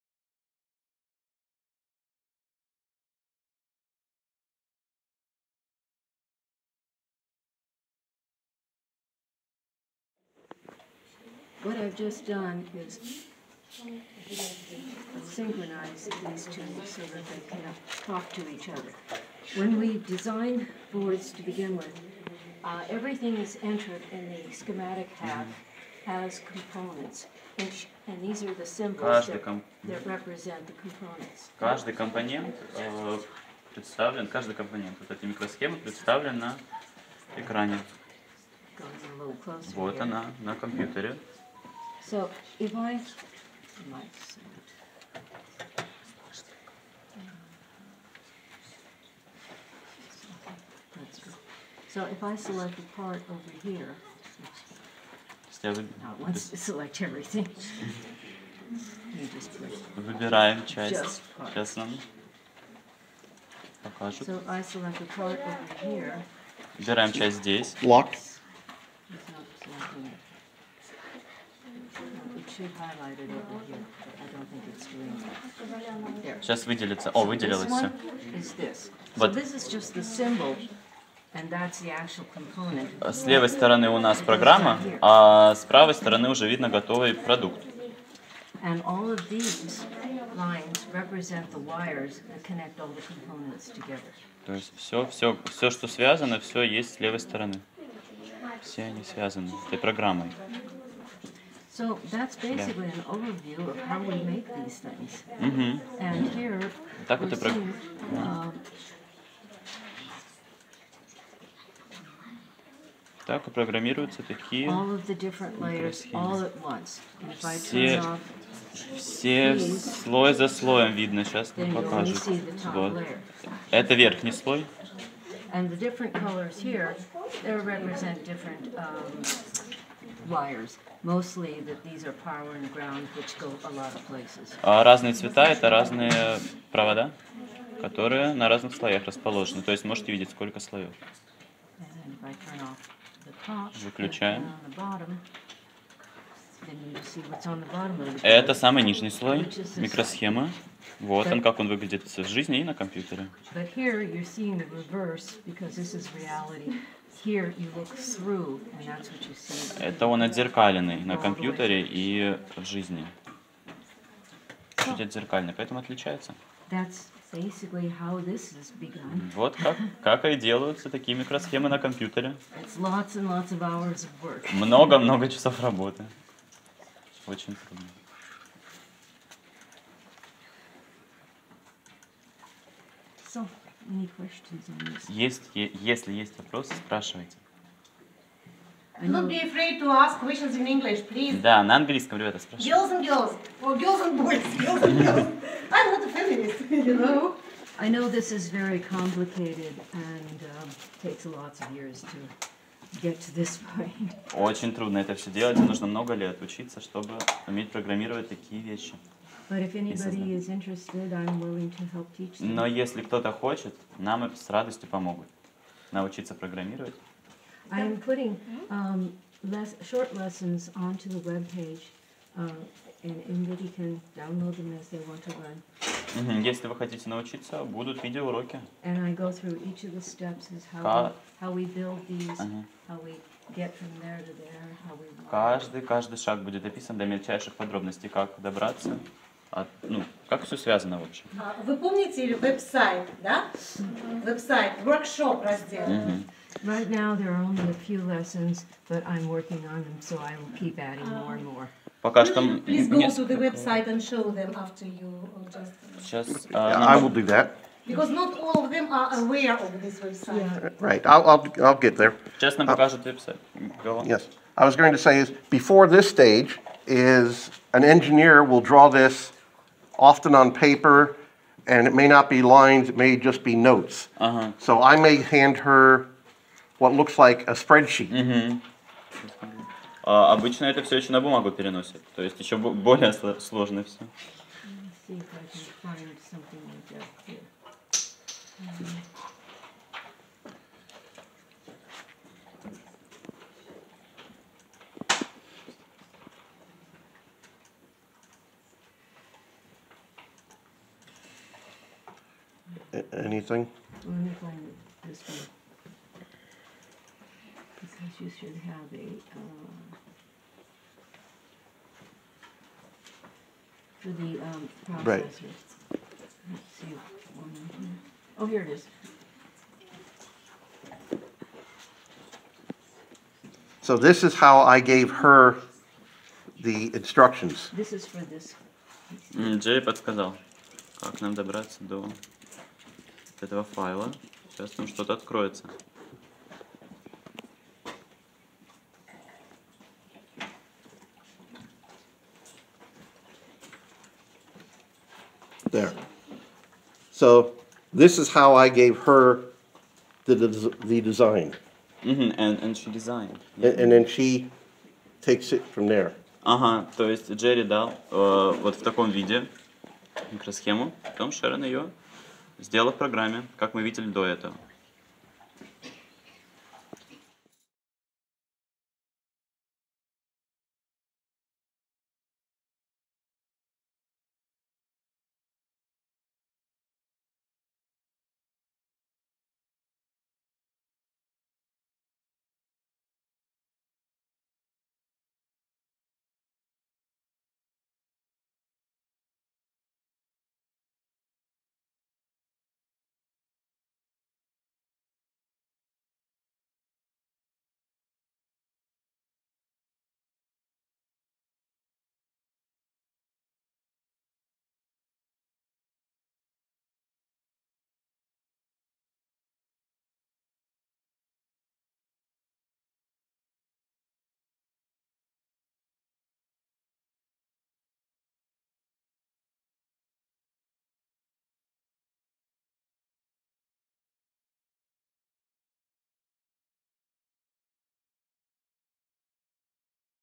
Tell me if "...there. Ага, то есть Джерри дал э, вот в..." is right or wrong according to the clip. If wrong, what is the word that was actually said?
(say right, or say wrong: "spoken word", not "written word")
right.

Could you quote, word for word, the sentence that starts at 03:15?
I'm not a feminist, you know.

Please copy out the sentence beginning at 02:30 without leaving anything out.
Вот он, как он выглядит в жизни и на компьютере.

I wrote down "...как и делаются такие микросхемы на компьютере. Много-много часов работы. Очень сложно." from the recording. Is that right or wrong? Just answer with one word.
wrong.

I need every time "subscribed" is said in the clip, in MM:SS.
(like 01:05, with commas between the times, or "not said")
not said.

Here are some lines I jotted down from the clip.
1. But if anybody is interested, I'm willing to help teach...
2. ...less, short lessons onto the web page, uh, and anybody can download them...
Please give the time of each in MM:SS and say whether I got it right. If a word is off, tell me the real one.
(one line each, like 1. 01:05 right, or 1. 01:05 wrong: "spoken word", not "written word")
1. 03:29 right
2. 03:39 right.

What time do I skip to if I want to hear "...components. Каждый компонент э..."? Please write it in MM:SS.
00:30.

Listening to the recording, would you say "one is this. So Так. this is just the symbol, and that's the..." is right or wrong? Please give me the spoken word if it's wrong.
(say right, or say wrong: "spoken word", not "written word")
wrong: "Вот", not "Так".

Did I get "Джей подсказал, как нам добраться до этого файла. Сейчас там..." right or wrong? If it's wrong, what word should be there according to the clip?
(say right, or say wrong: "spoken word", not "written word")
right.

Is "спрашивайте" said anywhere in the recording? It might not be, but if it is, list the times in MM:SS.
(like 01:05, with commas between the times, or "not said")
03:06, 03:12.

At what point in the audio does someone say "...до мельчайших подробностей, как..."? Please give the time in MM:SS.
03:56.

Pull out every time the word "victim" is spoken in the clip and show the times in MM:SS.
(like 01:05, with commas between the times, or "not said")
not said.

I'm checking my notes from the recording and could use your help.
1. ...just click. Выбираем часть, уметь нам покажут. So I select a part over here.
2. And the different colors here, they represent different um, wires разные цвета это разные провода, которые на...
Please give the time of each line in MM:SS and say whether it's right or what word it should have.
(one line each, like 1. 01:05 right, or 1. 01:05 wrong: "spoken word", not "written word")
1. 00:59 wrong: "часть", not "уметь"
2. 02:05 right.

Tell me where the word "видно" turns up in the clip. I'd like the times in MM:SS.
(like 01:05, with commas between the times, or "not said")
01:26, 02:00.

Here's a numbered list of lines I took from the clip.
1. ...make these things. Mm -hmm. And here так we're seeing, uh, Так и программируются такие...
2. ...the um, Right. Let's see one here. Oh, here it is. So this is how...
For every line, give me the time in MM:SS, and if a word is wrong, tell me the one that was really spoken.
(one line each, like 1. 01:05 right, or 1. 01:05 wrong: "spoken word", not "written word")
1. 01:44 right
2. 05:14 right.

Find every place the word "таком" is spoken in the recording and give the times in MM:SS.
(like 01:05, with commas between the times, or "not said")
05:58.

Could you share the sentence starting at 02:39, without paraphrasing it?
Это он отзеркаленный на компьютере и в жизни.